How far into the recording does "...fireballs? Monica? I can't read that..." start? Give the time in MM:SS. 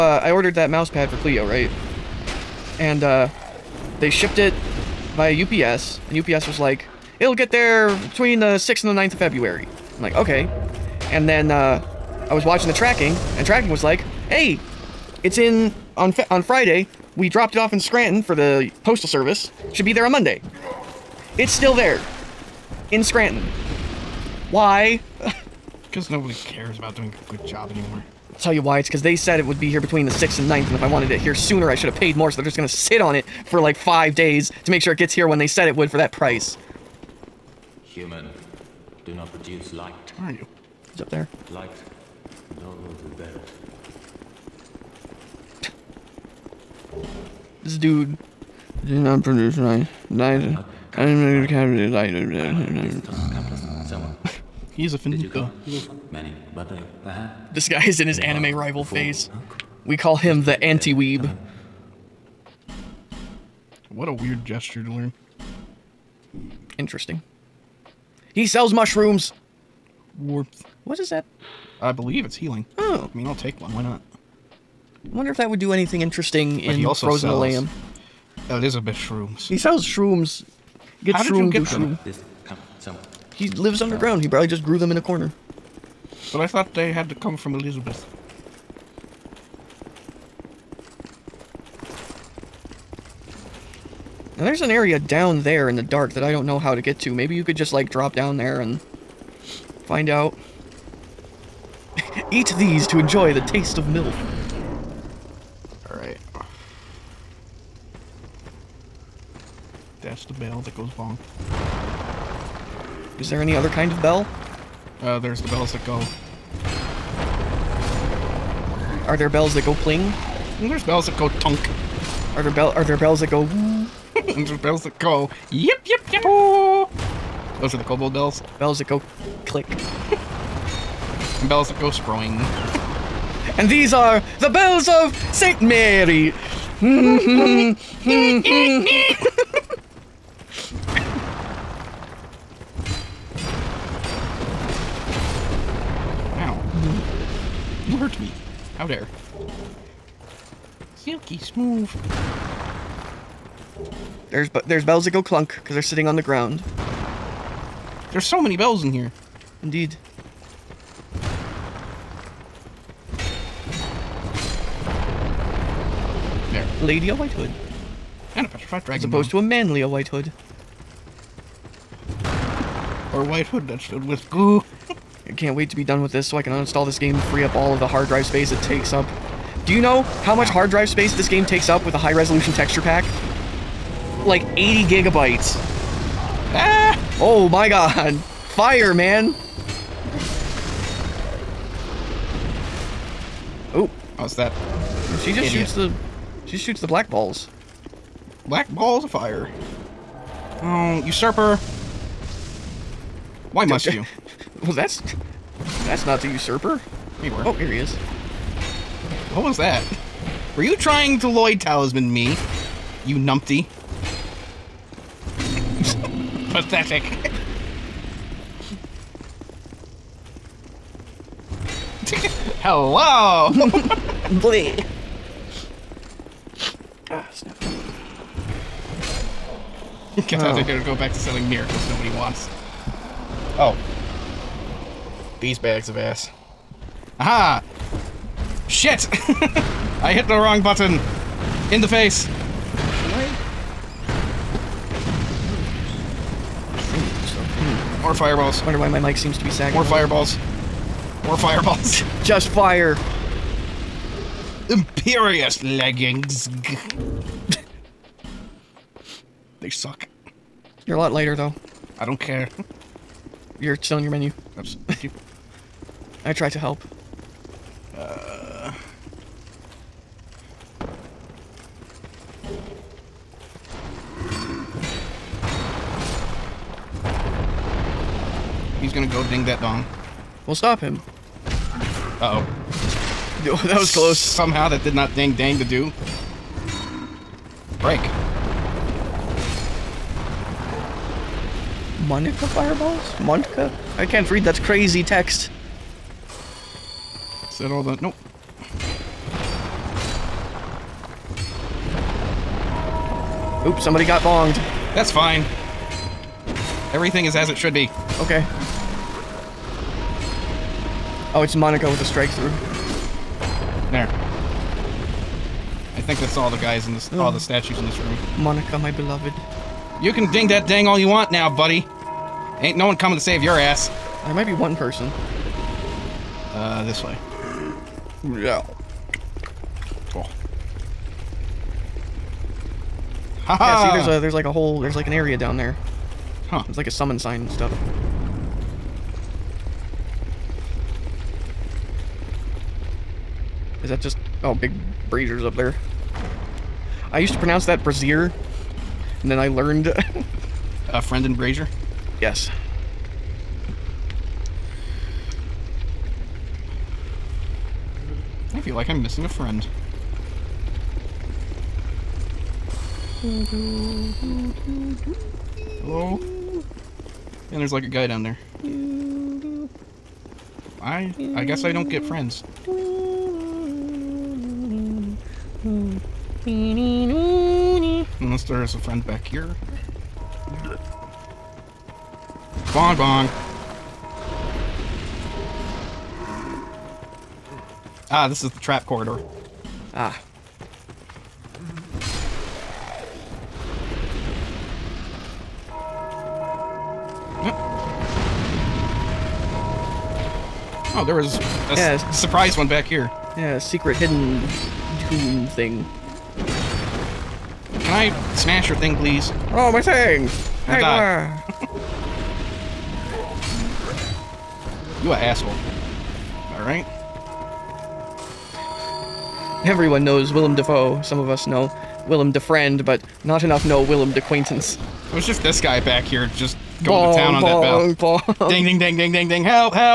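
04:52.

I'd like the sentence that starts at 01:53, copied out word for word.
Is there any other kind of bell?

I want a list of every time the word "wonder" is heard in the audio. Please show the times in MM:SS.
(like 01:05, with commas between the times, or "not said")
01:15, 04:08.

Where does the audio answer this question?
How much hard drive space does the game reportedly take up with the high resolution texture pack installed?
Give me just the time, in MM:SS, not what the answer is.
03:04.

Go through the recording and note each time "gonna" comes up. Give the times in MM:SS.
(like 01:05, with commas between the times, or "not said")
04:38.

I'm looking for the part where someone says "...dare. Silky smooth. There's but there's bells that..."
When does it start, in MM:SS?
02:28.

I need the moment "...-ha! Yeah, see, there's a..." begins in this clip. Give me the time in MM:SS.
05:33.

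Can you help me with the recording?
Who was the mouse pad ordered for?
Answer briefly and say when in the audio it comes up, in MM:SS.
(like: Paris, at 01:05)
Cleo, at 00:01.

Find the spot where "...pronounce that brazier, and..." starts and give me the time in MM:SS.
05:47.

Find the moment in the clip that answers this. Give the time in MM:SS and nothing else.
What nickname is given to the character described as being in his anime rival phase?
01:00.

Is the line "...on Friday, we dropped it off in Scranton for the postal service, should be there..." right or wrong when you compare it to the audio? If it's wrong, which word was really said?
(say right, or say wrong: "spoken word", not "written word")
right.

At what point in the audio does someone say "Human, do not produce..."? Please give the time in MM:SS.
00:37.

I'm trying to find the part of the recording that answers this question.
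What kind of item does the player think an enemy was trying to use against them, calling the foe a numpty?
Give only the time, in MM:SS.
03:31.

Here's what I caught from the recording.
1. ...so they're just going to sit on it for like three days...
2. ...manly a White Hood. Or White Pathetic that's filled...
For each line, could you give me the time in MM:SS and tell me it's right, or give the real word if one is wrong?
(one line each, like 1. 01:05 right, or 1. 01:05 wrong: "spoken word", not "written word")
1. 00:32 wrong: "five", not "three"
2. 02:49 wrong: "Hood", not "Pathetic".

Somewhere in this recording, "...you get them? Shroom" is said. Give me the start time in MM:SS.
01:21.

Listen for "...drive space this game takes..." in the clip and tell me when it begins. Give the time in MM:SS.
03:00.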